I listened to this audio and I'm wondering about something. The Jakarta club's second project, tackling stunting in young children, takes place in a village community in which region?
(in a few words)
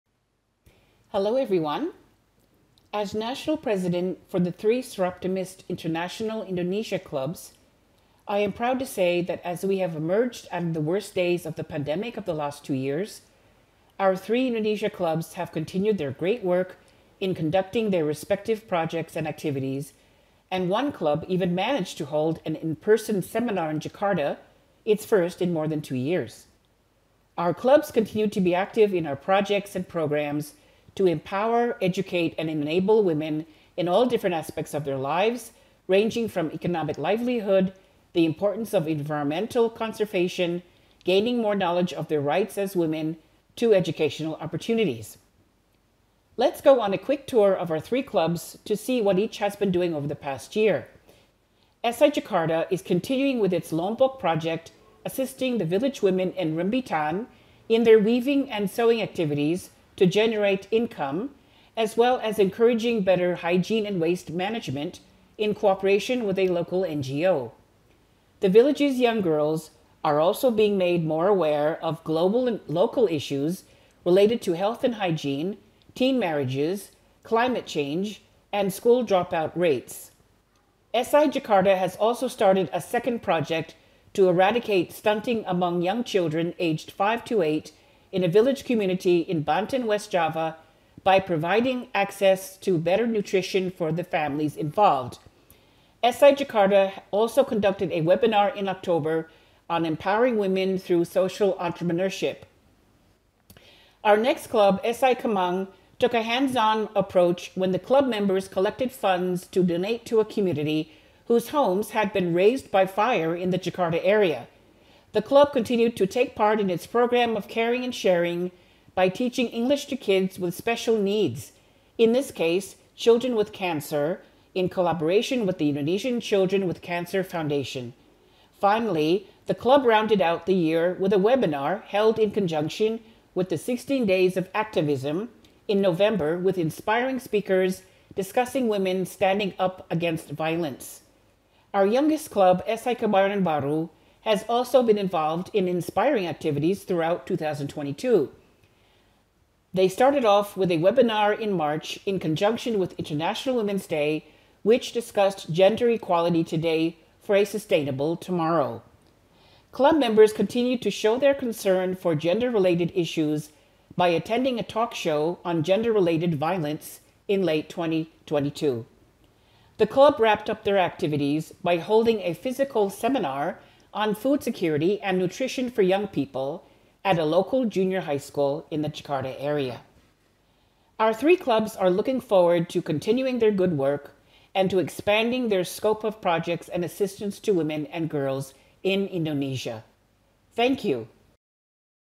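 Banten, West Java.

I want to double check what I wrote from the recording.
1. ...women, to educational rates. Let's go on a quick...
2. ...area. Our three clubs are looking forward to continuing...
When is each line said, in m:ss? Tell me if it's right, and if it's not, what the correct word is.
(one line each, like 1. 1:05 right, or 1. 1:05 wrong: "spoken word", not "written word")
1. 0:42 wrong: "opportunities", not "rates"
2. 2:59 right.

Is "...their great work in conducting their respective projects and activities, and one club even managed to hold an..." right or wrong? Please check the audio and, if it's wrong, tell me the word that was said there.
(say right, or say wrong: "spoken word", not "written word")
right.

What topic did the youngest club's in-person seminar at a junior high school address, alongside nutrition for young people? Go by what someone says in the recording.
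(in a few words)
Food security.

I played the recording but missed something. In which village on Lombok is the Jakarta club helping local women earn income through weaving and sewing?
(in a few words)
Rembitan.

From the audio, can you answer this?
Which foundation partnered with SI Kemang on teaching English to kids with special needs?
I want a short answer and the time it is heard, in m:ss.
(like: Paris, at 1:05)
Indonesian Children with Cancer Foundation, at 2:05.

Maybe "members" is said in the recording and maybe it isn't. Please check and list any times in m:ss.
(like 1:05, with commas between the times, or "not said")
1:48, 2:39.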